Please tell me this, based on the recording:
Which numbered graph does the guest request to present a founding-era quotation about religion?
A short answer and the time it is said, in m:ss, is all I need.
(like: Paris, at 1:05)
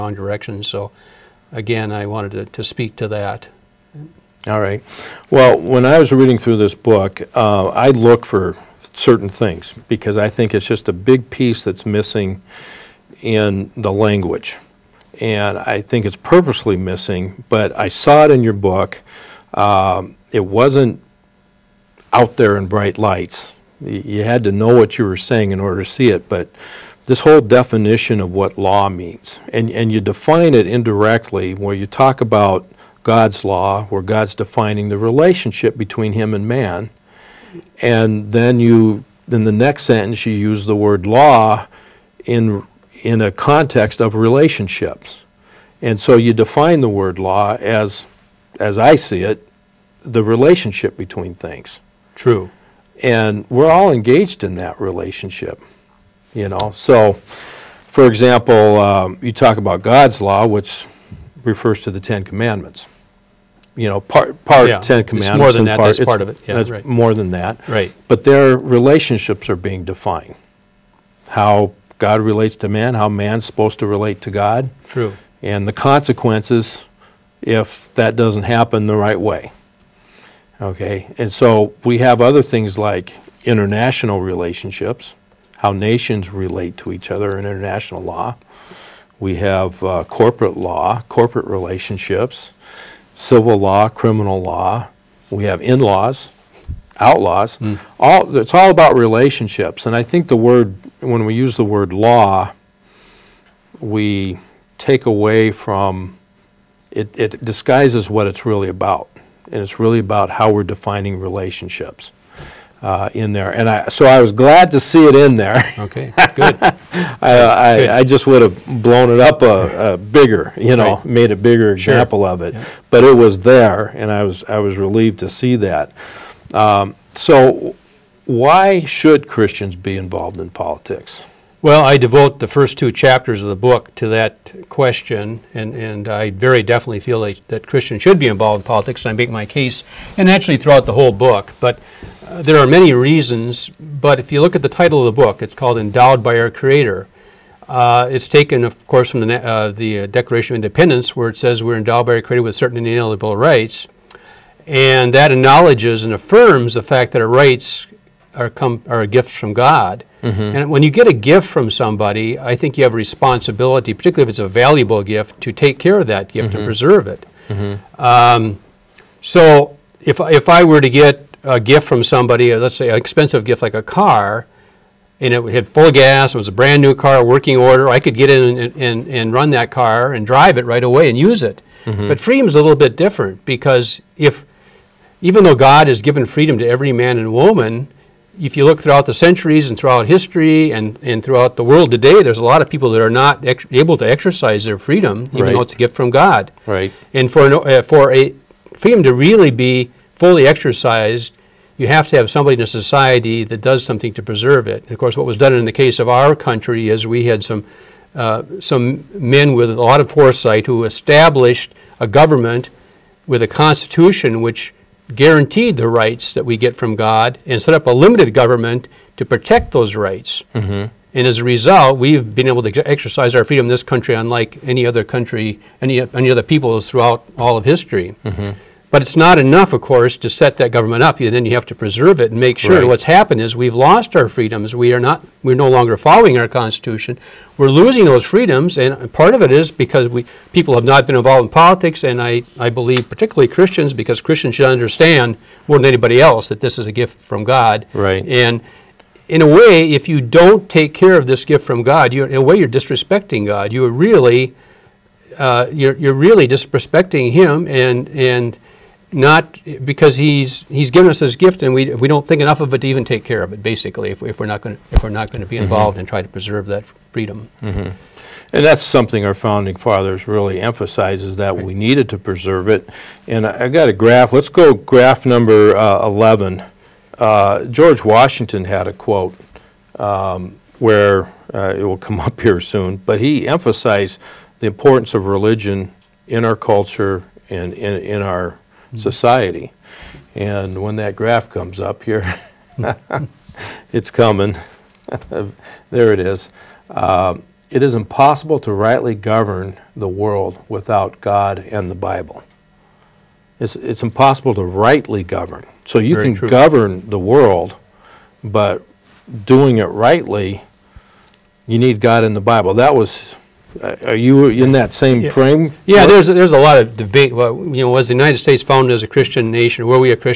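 11, at 4:36.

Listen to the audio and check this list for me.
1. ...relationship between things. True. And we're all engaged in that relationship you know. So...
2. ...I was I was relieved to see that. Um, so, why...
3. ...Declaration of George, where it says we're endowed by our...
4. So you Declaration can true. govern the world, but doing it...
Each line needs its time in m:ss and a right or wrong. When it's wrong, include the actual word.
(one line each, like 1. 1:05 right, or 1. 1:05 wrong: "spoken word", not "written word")
1. 0:50 right
2. 2:04 right
3. 2:30 wrong: "Independence", not "George"
4. 5:05 wrong: "Very", not "Declaration".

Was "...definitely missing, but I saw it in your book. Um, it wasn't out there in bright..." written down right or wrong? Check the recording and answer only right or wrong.
wrong.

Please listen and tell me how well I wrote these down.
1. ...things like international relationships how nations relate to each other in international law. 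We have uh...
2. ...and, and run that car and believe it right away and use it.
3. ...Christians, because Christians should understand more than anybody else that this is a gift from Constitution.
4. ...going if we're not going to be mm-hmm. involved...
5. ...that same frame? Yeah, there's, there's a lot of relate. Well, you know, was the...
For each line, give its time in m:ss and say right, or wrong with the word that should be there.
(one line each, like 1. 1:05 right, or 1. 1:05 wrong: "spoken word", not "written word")
1. 1:22 right
2. 2:58 wrong: "drive", not "believe"
3. 4:03 wrong: "God", not "Constitution"
4. 4:24 right
5. 5:14 wrong: "debate", not "relate".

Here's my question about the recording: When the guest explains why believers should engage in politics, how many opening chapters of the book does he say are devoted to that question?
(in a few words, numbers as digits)
2.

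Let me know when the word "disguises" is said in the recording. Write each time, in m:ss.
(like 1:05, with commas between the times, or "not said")
1:47.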